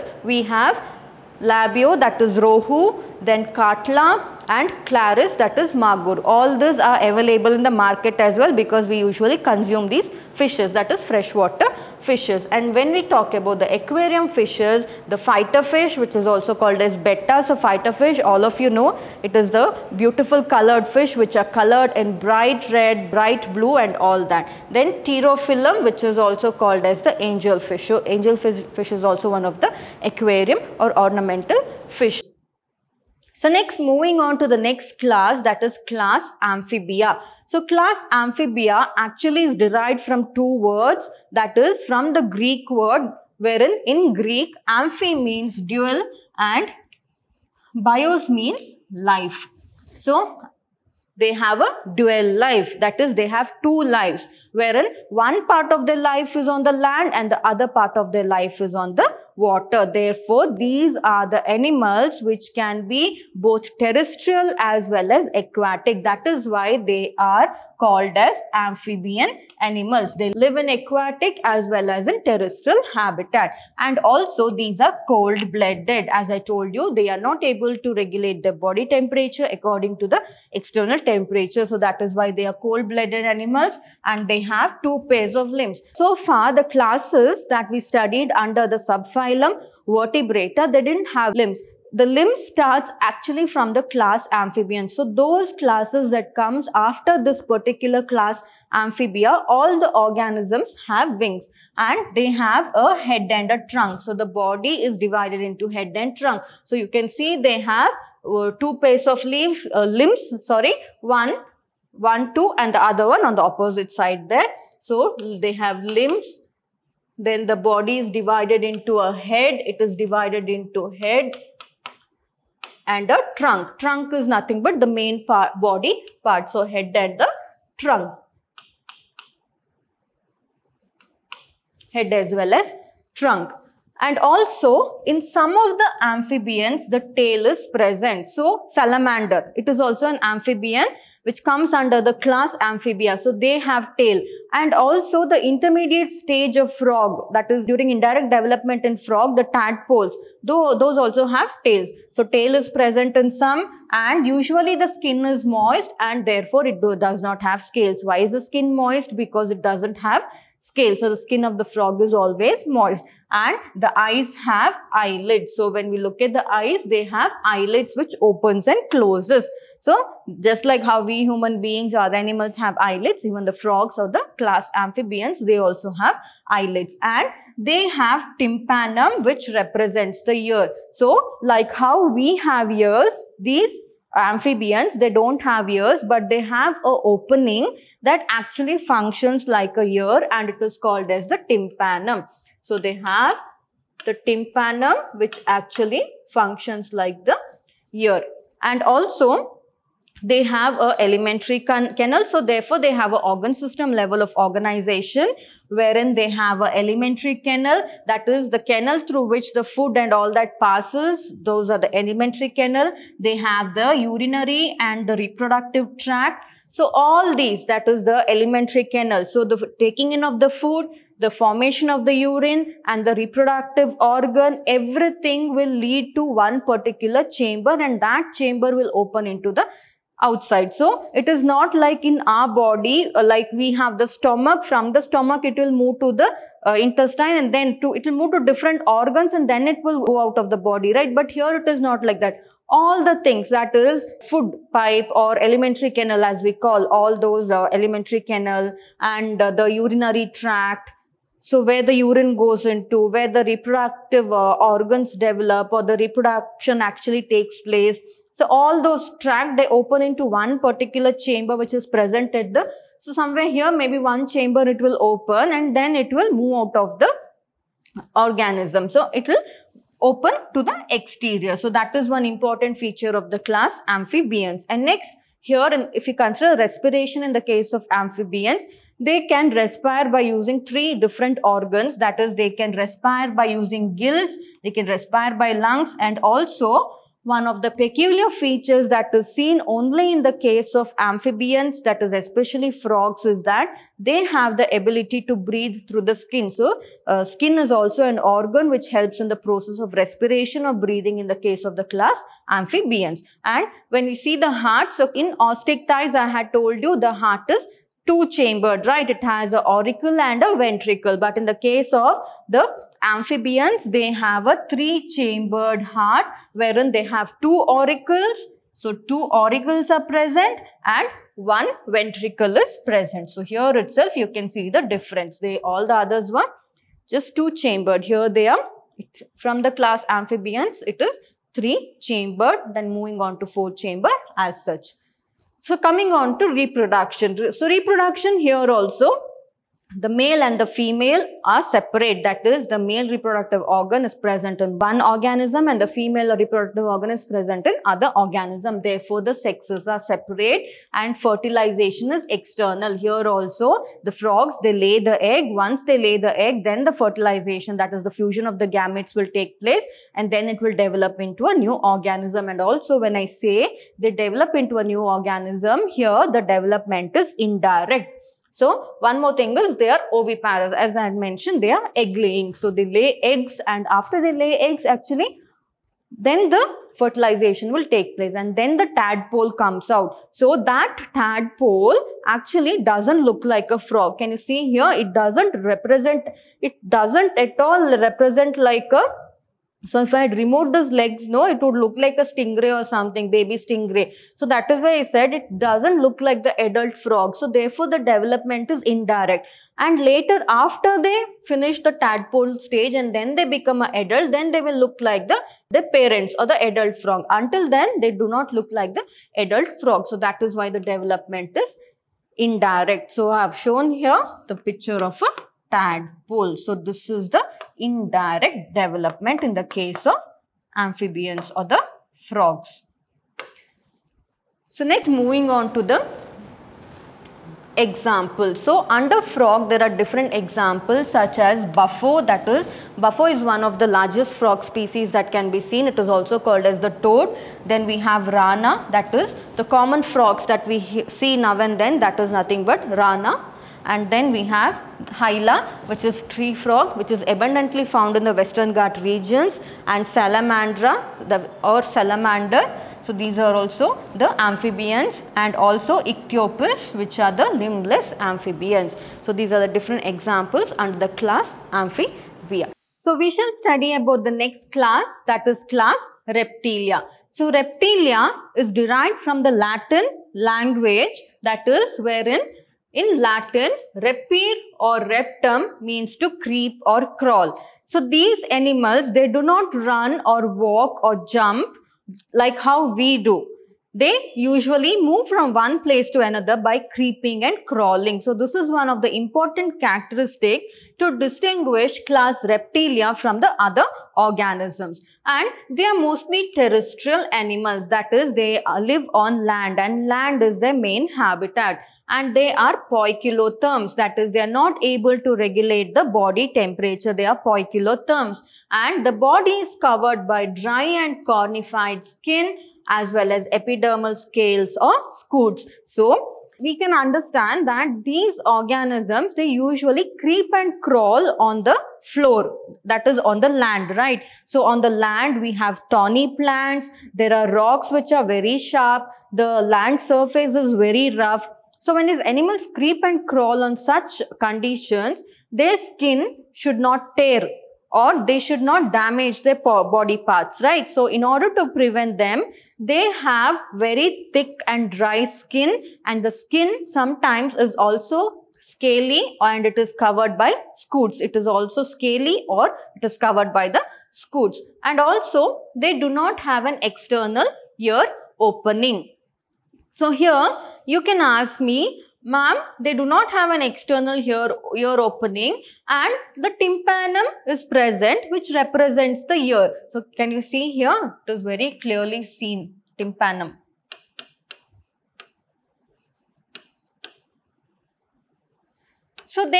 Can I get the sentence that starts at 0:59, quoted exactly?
Therefore, these are the animals which can be both terrestrial as well as aquatic.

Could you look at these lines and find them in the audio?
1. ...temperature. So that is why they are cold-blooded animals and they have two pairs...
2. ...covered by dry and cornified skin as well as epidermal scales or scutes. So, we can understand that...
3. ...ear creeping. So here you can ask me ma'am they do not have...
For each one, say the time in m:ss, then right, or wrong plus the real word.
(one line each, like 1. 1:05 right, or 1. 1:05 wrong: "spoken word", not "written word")
1. 1:20 right
2. 8:29 right
3. 9:17 wrong: "opening", not "creeping".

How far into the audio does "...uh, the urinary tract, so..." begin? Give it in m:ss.
4:09.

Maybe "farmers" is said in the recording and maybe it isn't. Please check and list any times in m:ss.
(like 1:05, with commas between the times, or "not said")
not said.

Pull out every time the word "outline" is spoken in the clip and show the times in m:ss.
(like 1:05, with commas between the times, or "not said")
not said.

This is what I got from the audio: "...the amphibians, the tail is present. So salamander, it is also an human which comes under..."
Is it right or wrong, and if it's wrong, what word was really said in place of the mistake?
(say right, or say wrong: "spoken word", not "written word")
wrong: "amphibian", not "human".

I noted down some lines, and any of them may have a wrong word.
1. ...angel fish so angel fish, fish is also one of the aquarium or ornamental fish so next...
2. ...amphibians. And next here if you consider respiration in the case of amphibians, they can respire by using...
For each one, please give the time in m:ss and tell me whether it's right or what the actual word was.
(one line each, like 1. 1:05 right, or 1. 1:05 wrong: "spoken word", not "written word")
1. 0:27 right
2. 4:33 right.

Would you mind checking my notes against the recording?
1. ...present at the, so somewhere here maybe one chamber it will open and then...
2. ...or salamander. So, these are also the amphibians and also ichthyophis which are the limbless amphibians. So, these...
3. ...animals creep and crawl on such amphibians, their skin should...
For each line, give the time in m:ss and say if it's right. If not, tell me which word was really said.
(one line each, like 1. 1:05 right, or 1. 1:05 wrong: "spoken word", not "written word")
1. 4:21 right
2. 7:31 right
3. 8:52 wrong: "conditions", not "amphibians".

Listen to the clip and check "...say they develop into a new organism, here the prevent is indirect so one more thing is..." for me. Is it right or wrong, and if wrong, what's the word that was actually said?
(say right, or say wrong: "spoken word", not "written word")
wrong: "development", not "prevent".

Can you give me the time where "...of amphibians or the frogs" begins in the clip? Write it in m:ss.
7:00.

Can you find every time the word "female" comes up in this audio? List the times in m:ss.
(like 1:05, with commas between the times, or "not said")
5:40, 5:45.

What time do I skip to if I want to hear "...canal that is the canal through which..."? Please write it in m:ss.
3:27.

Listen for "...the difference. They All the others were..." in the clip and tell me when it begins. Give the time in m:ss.
5:24.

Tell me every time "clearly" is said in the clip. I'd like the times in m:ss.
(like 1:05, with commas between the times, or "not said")
9:31.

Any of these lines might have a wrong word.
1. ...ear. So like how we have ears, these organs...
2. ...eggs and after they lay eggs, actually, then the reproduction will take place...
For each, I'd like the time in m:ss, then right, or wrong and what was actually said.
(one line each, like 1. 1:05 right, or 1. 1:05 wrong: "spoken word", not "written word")
1. 3:00 wrong: "amphibians", not "organs"
2. 6:13 wrong: "fertilization", not "reproduction".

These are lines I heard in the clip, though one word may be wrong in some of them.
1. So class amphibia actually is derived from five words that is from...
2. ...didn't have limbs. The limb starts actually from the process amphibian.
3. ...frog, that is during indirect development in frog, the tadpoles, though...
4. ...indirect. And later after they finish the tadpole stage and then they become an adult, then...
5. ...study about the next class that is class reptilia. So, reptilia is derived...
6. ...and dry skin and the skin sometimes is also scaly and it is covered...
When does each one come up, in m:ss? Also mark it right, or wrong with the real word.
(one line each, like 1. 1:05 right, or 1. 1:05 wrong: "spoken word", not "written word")
1. 0:37 wrong: "two", not "five"
2. 1:30 wrong: "class", not "process"
3. 2:26 right
4. 6:38 right
5. 7:43 right
6. 9:04 right.